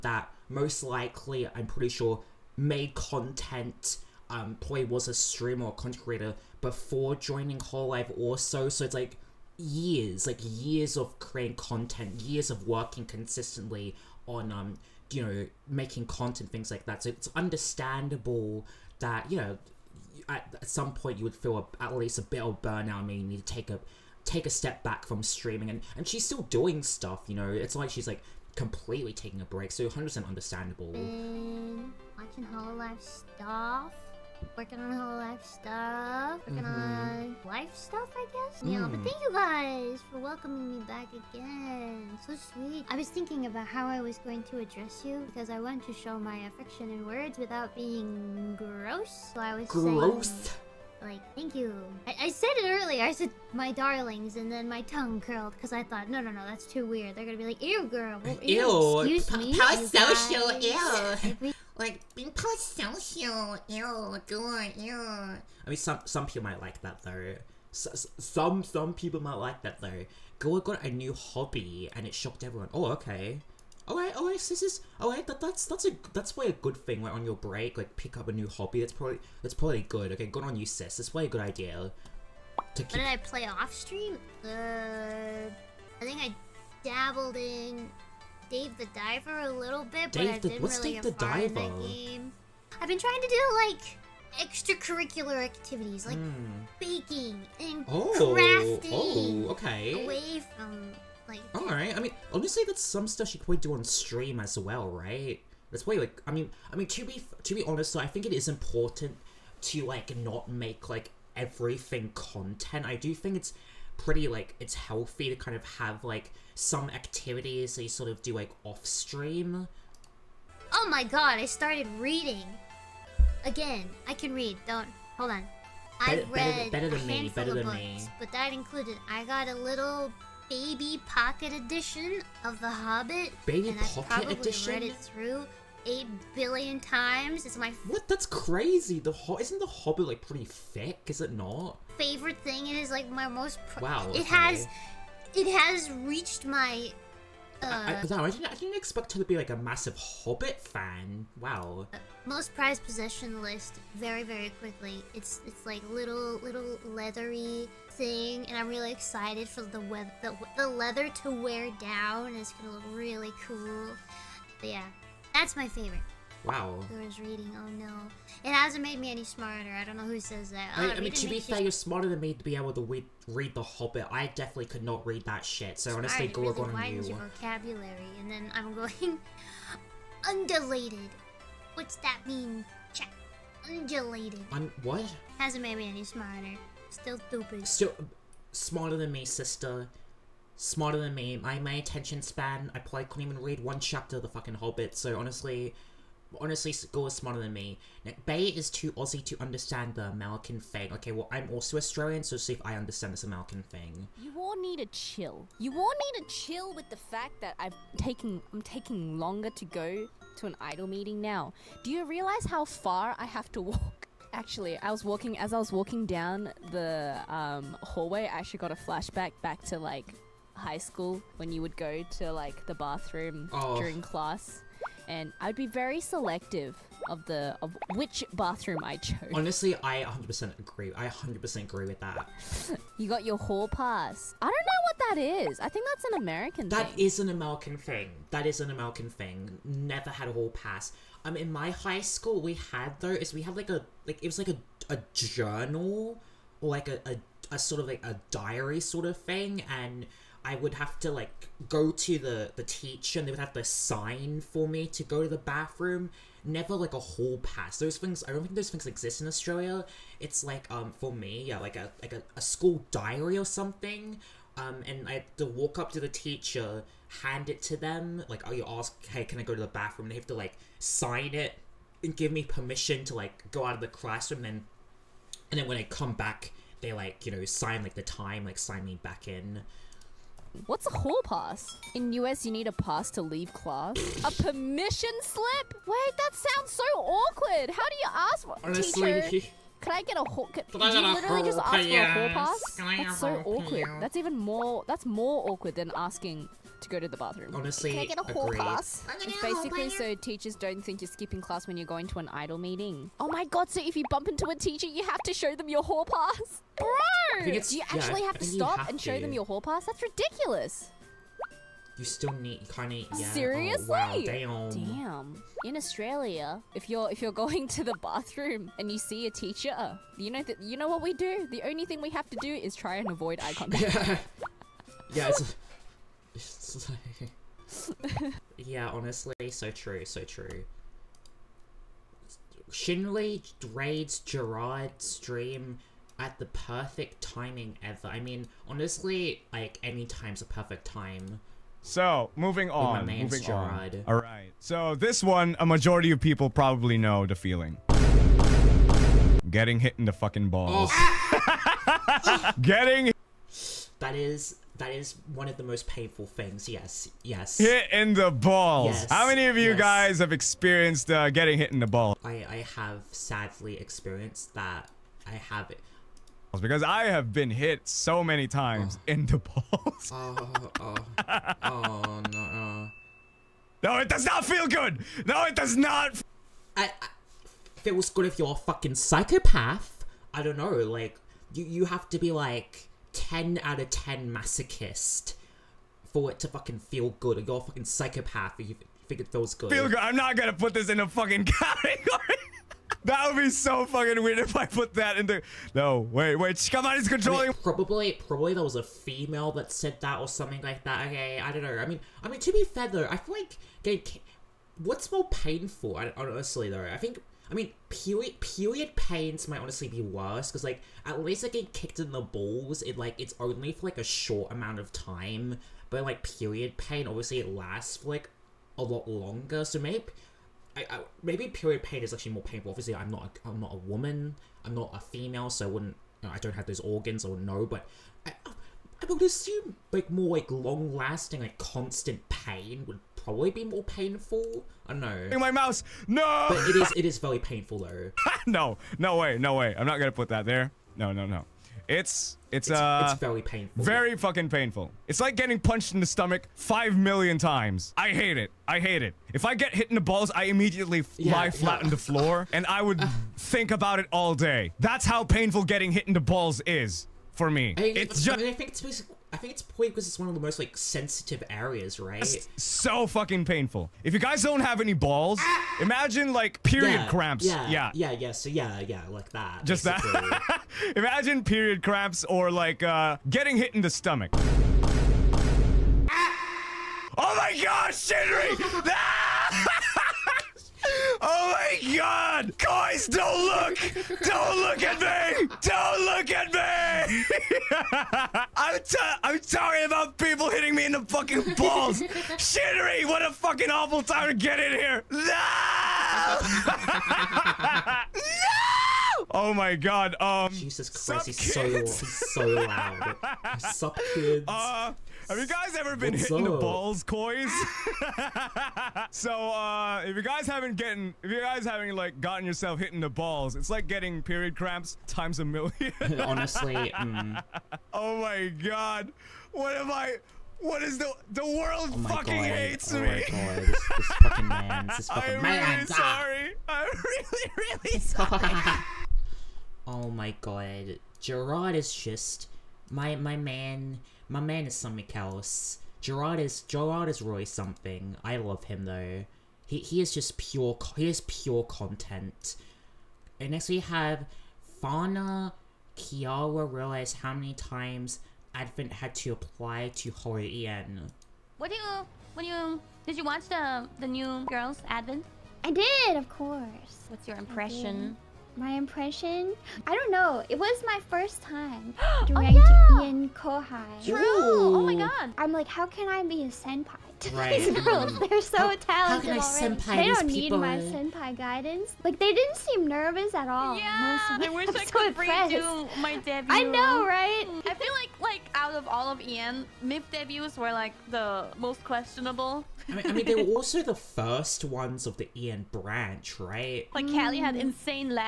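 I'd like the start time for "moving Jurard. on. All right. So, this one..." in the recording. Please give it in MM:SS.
05:43.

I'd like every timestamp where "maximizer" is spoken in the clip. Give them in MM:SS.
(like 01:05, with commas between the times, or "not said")
not said.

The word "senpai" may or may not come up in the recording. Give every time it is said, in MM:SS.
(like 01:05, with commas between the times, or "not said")
09:26, 09:30.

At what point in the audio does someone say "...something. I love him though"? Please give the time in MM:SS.
08:57.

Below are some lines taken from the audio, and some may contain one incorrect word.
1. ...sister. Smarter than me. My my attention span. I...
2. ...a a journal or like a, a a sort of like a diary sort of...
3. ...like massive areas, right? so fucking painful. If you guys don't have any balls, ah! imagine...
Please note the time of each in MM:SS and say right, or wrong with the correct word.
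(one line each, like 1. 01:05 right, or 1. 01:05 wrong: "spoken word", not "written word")
1. 03:09 right
2. 04:04 right
3. 07:40 wrong: "sensitive", not "massive".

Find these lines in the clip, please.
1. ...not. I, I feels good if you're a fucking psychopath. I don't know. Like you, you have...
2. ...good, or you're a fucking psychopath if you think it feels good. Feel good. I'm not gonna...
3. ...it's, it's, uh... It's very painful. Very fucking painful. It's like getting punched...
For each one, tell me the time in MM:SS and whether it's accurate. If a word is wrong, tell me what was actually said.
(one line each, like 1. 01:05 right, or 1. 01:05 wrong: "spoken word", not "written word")
1. 06:15 right
2. 06:27 right
3. 07:22 right.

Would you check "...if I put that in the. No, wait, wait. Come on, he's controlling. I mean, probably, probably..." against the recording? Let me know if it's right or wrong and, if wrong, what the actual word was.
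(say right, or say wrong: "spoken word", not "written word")
right.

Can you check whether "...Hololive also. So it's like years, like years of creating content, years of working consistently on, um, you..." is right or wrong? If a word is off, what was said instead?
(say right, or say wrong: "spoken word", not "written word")
right.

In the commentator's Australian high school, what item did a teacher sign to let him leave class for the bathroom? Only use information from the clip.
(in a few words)
School diary.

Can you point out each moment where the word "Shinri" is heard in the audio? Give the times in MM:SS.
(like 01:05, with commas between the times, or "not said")
05:32, 07:57.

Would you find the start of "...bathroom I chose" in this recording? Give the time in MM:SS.
03:48.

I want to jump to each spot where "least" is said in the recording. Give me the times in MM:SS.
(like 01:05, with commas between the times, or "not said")
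00:21, 06:51.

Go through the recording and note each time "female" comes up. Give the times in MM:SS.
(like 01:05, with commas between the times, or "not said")
06:38, 07:05.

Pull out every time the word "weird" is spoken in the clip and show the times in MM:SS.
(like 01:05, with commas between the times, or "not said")
00:56, 06:34.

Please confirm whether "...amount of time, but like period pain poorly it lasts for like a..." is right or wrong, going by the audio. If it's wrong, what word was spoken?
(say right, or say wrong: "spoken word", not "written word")
wrong: "obviously", not "poorly".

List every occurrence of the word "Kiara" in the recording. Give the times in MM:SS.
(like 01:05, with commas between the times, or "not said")
09:05.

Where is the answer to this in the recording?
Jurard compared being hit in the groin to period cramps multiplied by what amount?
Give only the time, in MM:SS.
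08:35.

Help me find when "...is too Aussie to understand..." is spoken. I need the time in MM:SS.
03:18.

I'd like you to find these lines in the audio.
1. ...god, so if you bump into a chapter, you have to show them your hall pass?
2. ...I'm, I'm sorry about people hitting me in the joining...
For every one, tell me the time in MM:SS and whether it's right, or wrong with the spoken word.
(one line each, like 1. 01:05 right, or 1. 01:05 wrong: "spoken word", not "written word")
1. 05:03 wrong: "teacher", not "chapter"
2. 08:08 wrong: "fucking", not "joining".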